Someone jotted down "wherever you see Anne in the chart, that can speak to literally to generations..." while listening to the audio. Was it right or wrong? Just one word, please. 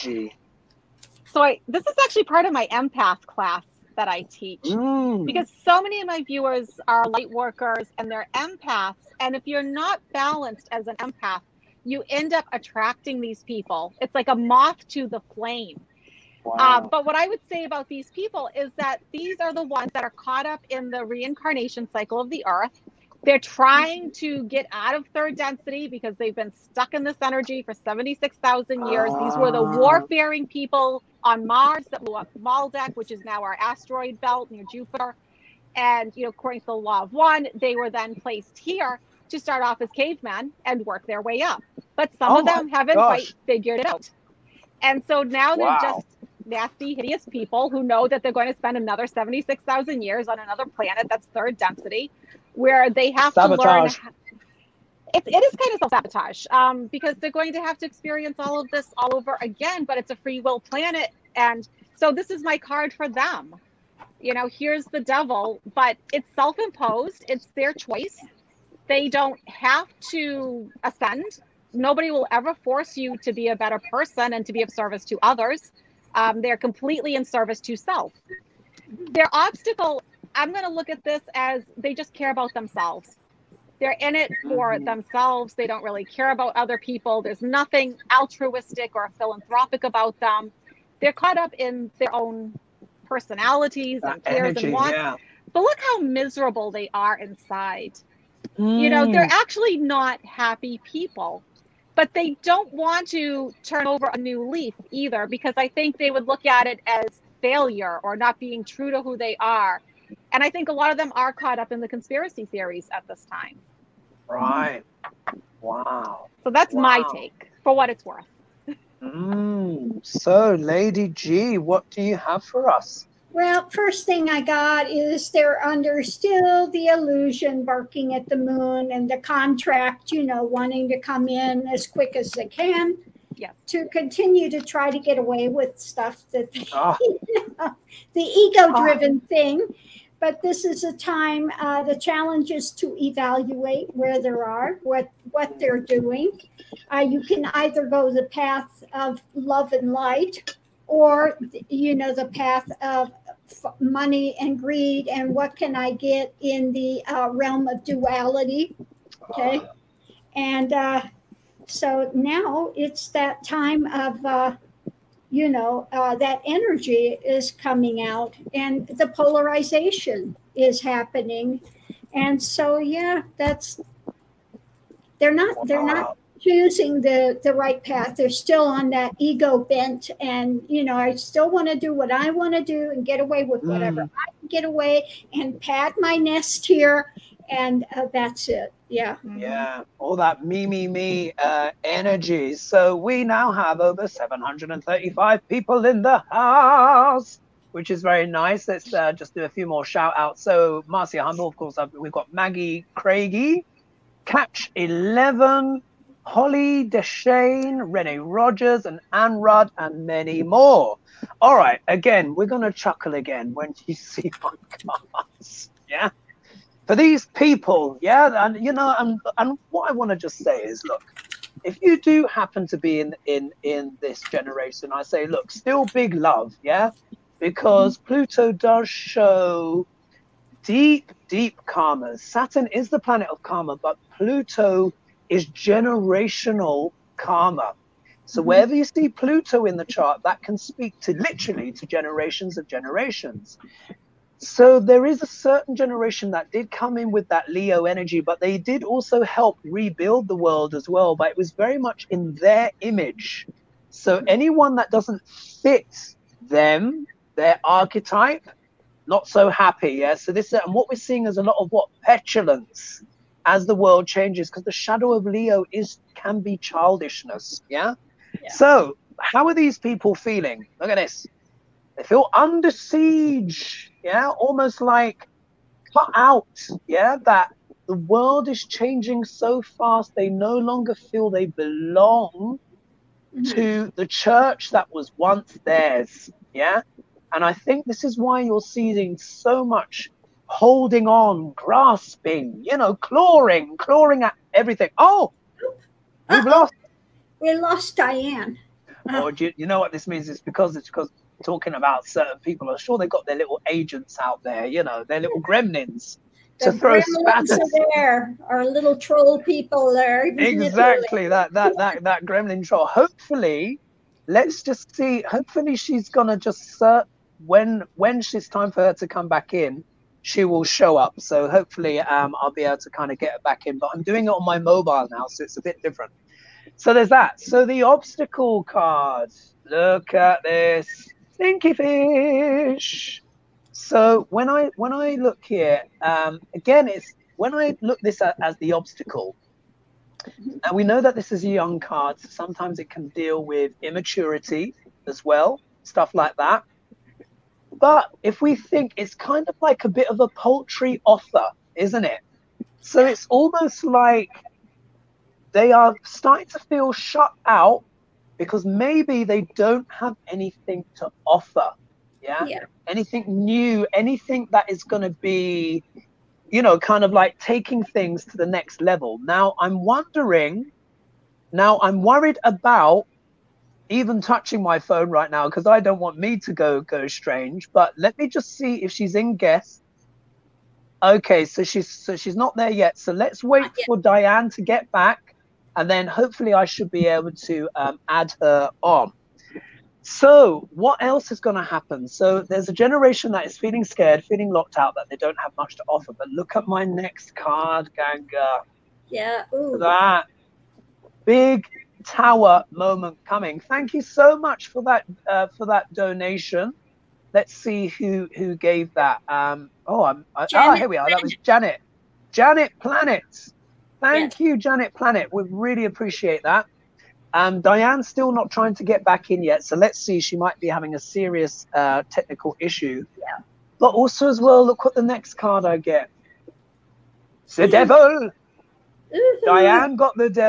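wrong.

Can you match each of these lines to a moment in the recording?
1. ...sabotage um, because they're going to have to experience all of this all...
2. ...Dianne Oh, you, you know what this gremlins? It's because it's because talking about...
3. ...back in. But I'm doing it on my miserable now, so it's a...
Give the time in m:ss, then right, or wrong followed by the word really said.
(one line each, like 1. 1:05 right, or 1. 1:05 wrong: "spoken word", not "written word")
1. 0:55 right
2. 4:57 wrong: "means", not "gremlins"
3. 5:23 wrong: "mobile", not "miserable".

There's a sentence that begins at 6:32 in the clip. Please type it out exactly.
So, there's a generation that is feeling scared, feeling locked out, that they don't have much to offer.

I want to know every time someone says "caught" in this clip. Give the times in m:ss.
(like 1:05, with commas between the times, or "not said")
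0:20, 1:31, 1:51.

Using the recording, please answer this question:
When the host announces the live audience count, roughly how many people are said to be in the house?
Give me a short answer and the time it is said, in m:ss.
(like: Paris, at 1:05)
Over 735, at 3:13.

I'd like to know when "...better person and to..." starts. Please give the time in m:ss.
1:13.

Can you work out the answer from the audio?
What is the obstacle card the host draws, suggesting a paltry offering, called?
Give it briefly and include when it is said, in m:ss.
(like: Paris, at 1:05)
Stinky fish, at 5:31.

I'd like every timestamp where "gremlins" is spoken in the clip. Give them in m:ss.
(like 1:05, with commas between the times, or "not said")
5:05, 5:12.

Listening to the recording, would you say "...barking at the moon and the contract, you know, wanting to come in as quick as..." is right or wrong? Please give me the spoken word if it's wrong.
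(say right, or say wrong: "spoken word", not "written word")
right.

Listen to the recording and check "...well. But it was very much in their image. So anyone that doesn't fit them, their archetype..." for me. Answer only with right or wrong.
right.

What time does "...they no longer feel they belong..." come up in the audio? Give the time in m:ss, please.
4:40.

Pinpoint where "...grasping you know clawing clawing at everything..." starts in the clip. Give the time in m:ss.
4:51.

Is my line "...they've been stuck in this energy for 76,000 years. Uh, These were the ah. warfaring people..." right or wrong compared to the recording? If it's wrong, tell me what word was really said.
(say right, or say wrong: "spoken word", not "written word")
right.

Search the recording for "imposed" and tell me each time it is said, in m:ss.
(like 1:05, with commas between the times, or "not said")
1:06.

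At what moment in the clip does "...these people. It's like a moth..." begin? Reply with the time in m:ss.
0:13.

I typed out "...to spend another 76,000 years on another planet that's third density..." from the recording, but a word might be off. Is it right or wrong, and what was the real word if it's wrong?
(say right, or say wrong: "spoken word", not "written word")
right.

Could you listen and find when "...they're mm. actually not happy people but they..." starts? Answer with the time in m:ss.
1:39.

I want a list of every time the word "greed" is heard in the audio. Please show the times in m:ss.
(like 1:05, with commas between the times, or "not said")
2:34.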